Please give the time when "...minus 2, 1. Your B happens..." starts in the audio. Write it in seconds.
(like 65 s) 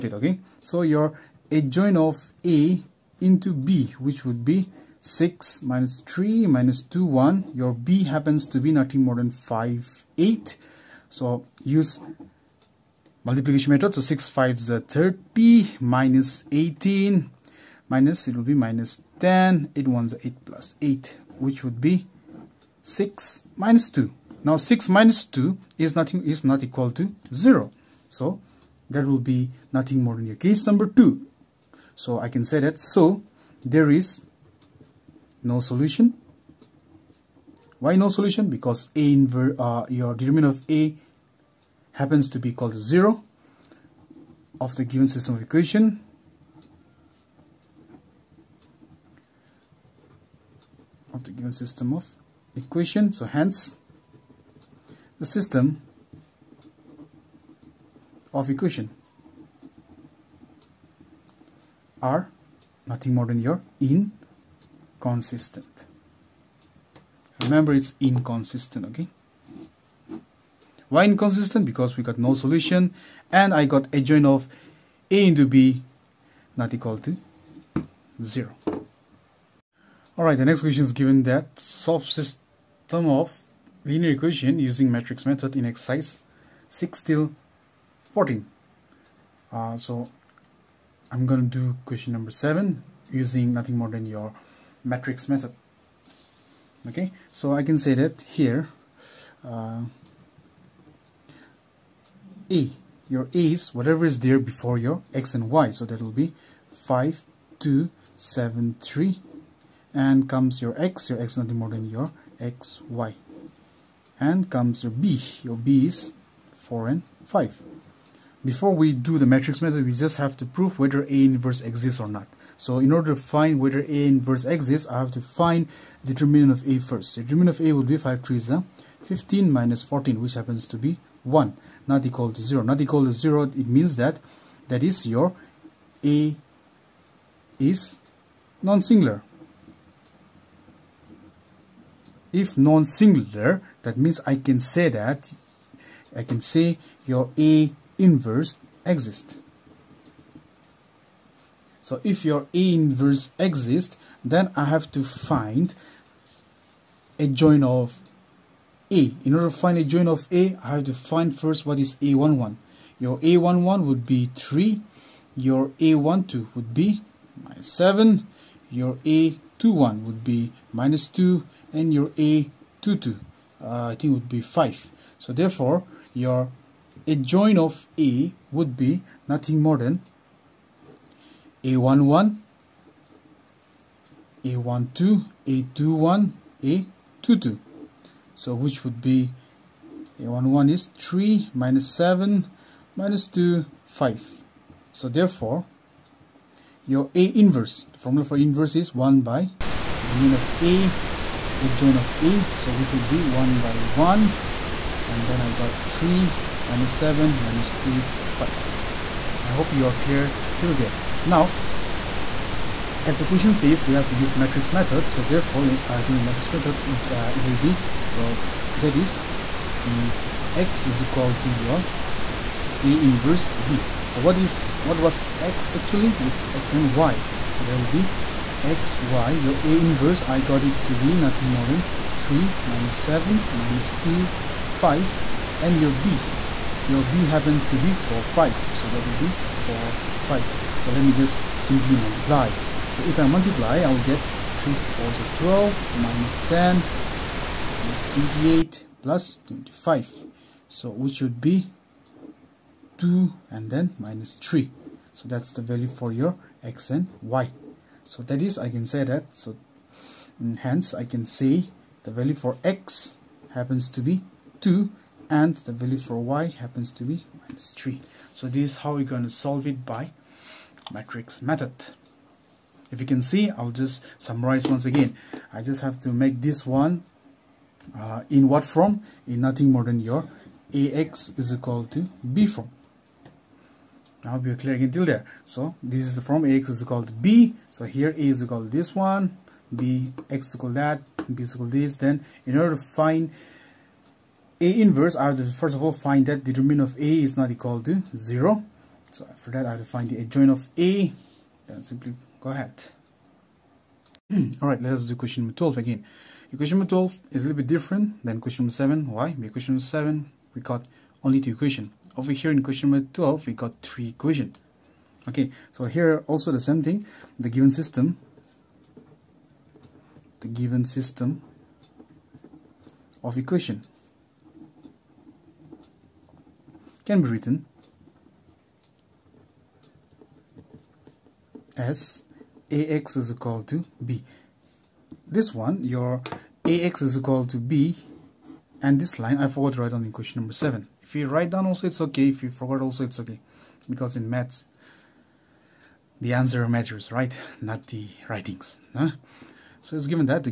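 6 s.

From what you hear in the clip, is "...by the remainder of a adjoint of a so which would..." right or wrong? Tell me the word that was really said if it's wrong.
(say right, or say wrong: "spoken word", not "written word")
right.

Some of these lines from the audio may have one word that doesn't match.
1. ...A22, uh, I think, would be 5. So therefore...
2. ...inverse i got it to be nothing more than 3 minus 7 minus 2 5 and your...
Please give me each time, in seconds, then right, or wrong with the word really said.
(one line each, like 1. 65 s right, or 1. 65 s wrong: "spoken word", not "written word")
1. 172 s right
2. 229 s right.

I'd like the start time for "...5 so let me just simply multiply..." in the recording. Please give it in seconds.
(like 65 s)
240 s.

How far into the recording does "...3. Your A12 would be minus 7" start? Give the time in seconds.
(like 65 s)
164 s.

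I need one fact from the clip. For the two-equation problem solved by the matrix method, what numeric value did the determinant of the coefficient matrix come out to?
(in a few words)
1.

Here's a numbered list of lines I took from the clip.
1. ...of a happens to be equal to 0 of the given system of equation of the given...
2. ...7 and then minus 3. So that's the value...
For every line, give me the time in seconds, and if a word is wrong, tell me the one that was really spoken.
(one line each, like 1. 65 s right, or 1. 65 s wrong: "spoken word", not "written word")
1. 40 s right
2. 252 s wrong: "2", not "7".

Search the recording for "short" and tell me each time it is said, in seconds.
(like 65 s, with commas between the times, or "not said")
not said.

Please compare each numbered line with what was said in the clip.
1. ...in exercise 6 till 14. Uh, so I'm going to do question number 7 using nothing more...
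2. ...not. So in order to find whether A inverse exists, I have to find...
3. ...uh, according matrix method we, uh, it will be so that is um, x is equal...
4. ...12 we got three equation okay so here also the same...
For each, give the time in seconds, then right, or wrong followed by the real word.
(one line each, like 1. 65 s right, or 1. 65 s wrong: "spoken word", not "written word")
1. 85 s right
2. 122 s right
3. 215 s right
4. 313 s right.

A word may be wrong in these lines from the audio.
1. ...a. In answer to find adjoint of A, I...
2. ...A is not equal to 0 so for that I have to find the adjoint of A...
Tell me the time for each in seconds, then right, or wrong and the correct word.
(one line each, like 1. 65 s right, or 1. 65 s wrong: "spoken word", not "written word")
1. 158 s wrong: "order", not "answer"
2. 297 s right.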